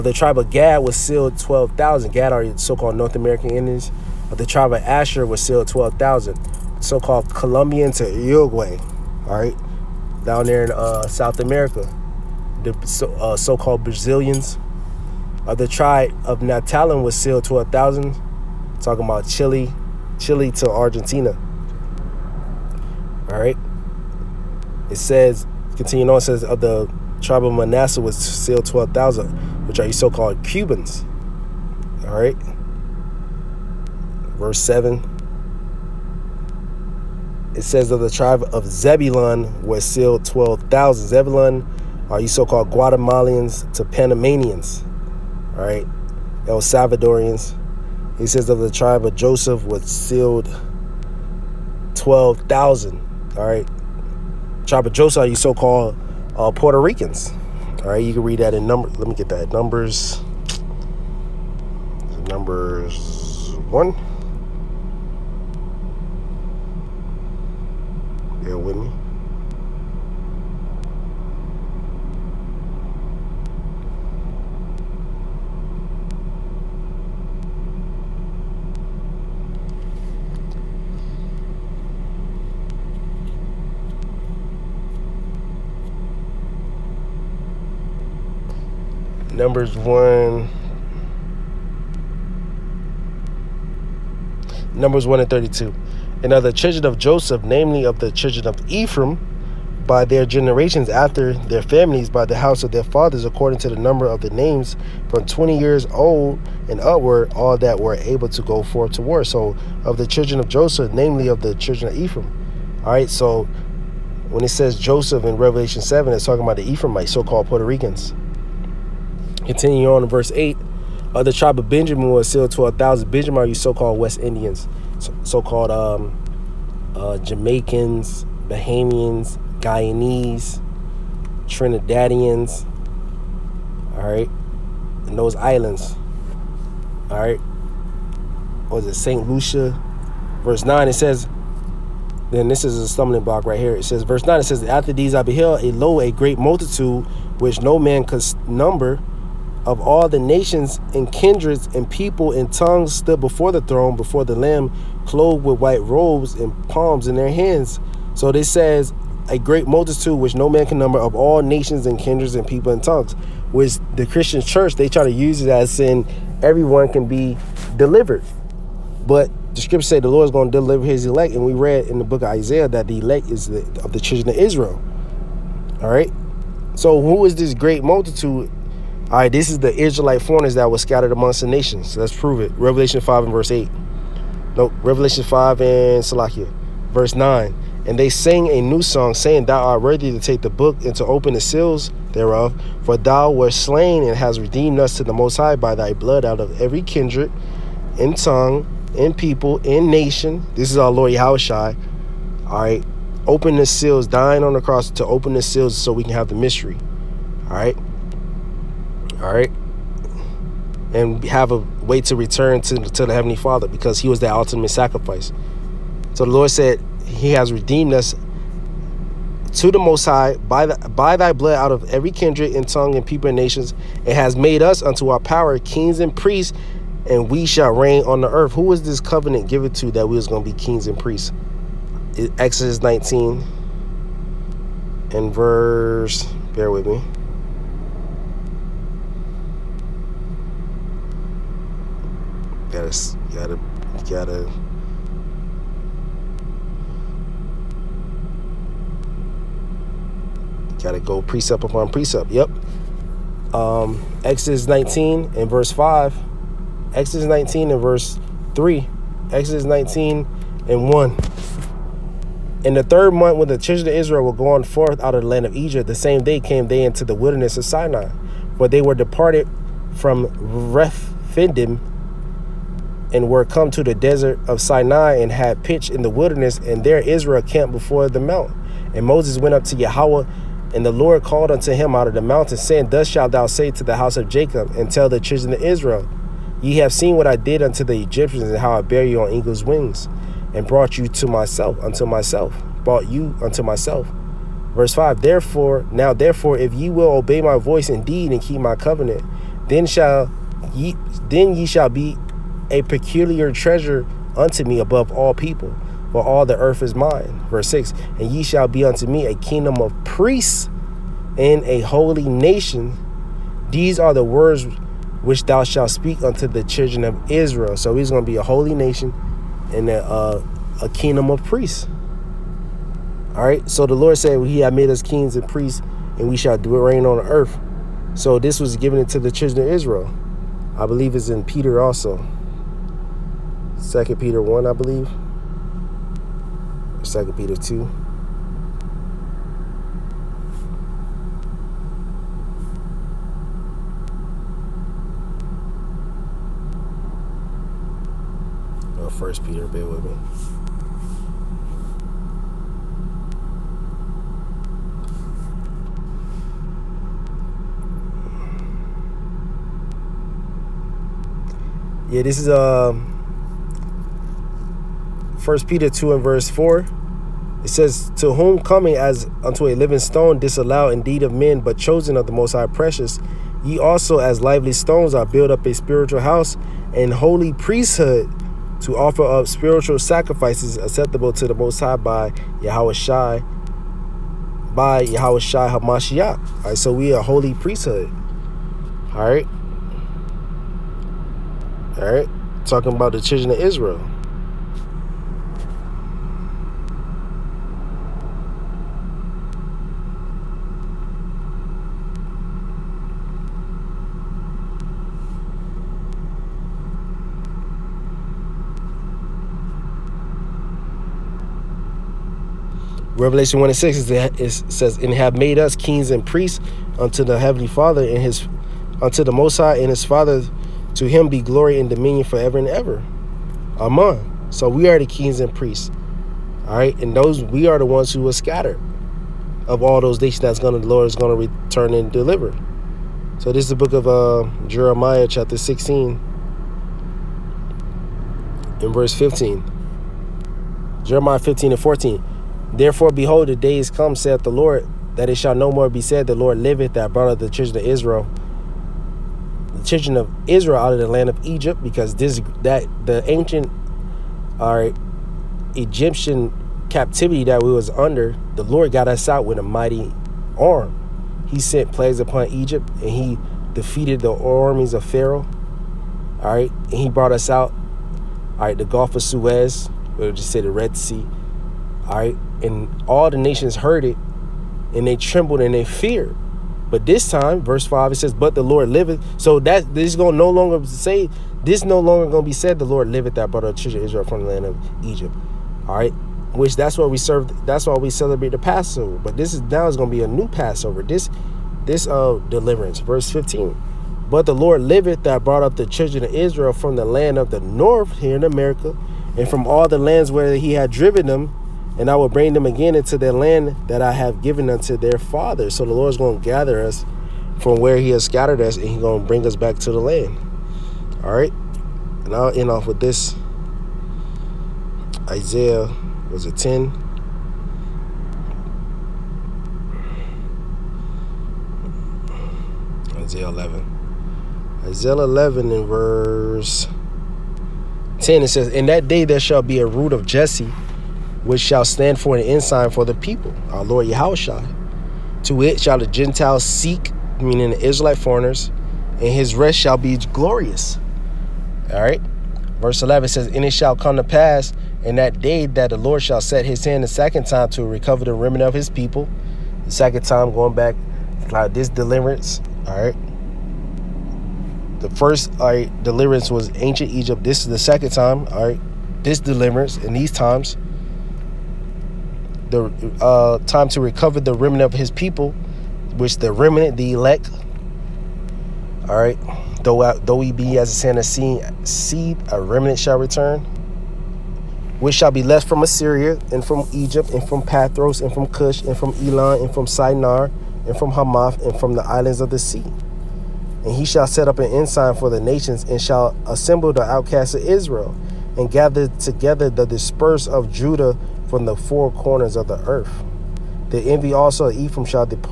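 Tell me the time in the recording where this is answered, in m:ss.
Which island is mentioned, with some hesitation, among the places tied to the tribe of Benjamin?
2:18.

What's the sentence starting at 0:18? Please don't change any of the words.
Talking about Chile, Chile to Argentina.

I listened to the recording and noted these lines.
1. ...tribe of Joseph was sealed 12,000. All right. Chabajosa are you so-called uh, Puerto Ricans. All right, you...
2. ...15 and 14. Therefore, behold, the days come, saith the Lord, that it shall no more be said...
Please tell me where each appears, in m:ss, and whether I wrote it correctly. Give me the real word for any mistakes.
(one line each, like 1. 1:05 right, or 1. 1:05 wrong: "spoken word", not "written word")
1. 0:48 right
2. 7:21 right.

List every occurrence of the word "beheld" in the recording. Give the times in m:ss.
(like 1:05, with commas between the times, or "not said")
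2:25.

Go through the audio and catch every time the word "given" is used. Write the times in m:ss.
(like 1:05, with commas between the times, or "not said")
3:49, 5:28, 8:24.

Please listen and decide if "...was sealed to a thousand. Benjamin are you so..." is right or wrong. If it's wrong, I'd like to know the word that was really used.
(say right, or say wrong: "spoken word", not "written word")
right.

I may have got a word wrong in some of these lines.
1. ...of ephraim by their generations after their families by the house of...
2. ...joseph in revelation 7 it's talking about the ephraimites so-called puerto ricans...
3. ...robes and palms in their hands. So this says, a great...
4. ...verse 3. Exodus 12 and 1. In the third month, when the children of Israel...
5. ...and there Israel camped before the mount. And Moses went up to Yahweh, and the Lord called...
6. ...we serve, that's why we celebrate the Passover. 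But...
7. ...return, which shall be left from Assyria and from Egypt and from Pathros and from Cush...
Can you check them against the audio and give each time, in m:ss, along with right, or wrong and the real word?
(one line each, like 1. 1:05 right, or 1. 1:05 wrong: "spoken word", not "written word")
1. 1:38 right
2. 1:54 right
3. 2:35 right
4. 4:17 wrong: "19", not "12"
5. 4:36 right
6. 8:07 right
7. 9:33 right.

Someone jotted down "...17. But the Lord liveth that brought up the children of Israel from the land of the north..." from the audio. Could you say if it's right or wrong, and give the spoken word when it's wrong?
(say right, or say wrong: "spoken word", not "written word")
wrong: "15", not "17".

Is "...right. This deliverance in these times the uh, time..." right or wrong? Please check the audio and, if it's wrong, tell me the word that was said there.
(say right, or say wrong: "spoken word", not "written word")
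right.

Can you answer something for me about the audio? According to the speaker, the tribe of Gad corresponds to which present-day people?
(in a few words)
North American Indians.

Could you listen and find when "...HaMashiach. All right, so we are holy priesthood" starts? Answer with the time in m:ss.
6:25.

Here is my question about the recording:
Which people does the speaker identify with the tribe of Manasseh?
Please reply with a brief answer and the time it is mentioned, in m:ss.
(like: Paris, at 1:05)
Cubans, at 0:30.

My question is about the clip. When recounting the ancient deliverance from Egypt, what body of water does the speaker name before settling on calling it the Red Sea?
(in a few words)
Gulf of Suez.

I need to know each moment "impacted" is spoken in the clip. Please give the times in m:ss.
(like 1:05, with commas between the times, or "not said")
not said.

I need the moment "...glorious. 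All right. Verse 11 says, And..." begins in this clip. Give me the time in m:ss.
9:00.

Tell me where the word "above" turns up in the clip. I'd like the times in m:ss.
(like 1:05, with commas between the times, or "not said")
5:04.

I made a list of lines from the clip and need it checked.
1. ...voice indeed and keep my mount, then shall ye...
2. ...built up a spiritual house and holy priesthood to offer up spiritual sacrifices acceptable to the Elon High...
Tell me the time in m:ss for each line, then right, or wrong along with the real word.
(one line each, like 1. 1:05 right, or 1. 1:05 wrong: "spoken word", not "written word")
1. 4:57 wrong: "covenant", not "mount"
2. 6:15 wrong: "Most", not "Elon".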